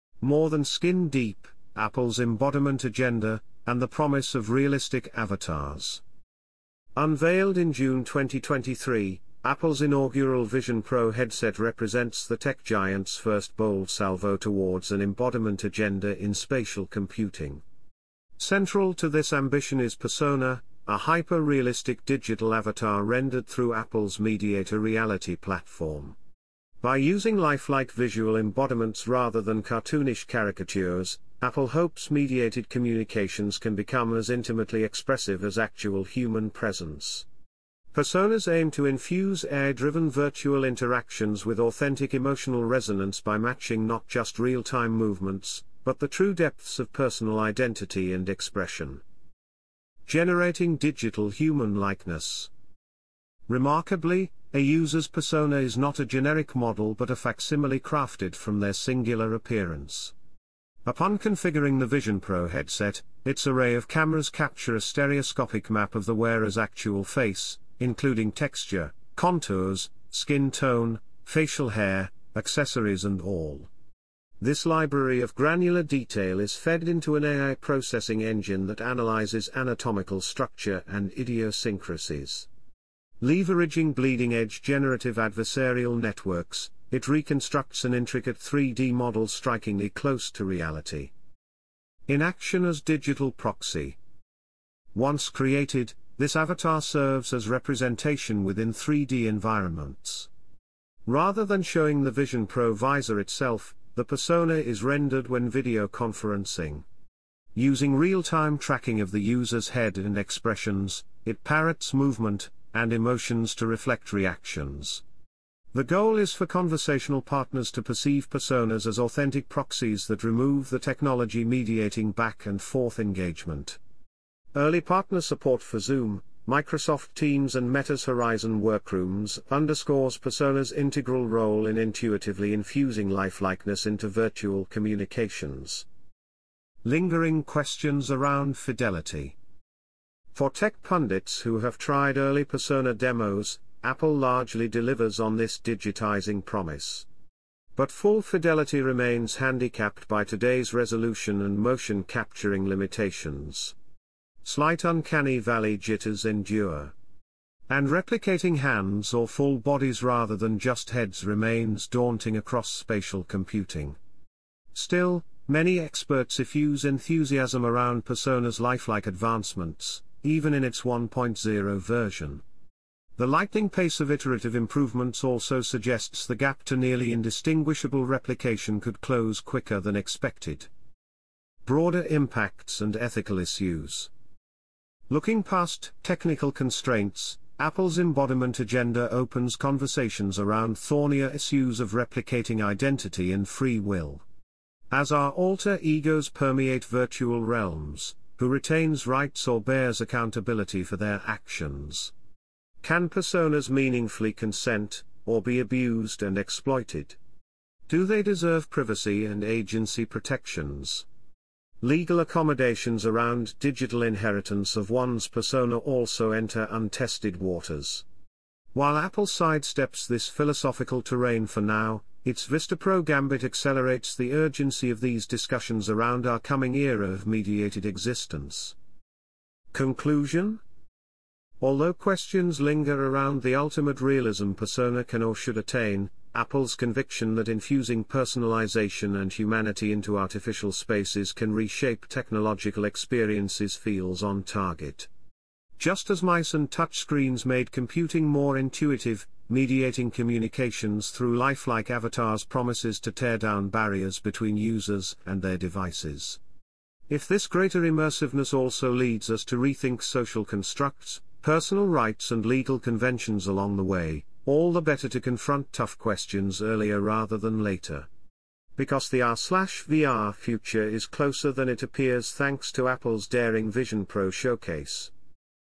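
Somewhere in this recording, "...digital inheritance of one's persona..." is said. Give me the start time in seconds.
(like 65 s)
213 s.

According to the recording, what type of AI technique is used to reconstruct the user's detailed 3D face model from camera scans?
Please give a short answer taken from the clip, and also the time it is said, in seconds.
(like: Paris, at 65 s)
generative adversarial networks, at 84 s.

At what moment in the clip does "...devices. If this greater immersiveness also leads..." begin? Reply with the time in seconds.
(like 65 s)
255 s.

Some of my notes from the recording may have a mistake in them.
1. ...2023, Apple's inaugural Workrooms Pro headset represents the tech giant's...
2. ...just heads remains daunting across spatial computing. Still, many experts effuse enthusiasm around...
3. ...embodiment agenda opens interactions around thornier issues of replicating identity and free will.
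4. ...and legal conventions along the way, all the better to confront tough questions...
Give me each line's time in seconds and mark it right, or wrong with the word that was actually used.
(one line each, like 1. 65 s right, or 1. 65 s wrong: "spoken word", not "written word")
1. 8 s wrong: "Vision", not "Workrooms"
2. 160 s right
3. 187 s wrong: "conversations", not "interactions"
4. 262 s right.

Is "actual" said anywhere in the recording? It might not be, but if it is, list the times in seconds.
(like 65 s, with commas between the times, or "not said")
35 s, 66 s.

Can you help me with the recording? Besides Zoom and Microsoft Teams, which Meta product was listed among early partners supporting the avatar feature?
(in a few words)
Horizon Workrooms.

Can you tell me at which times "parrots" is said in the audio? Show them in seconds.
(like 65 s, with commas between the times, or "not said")
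111 s.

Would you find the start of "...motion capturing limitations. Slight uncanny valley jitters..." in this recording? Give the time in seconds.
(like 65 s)
151 s.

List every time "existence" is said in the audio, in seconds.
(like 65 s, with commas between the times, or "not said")
227 s.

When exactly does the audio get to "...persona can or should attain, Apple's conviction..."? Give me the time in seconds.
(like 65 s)
234 s.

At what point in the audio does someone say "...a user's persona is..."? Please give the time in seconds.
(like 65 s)
54 s.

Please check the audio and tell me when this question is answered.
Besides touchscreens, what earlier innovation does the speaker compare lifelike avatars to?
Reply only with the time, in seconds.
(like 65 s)
246 s.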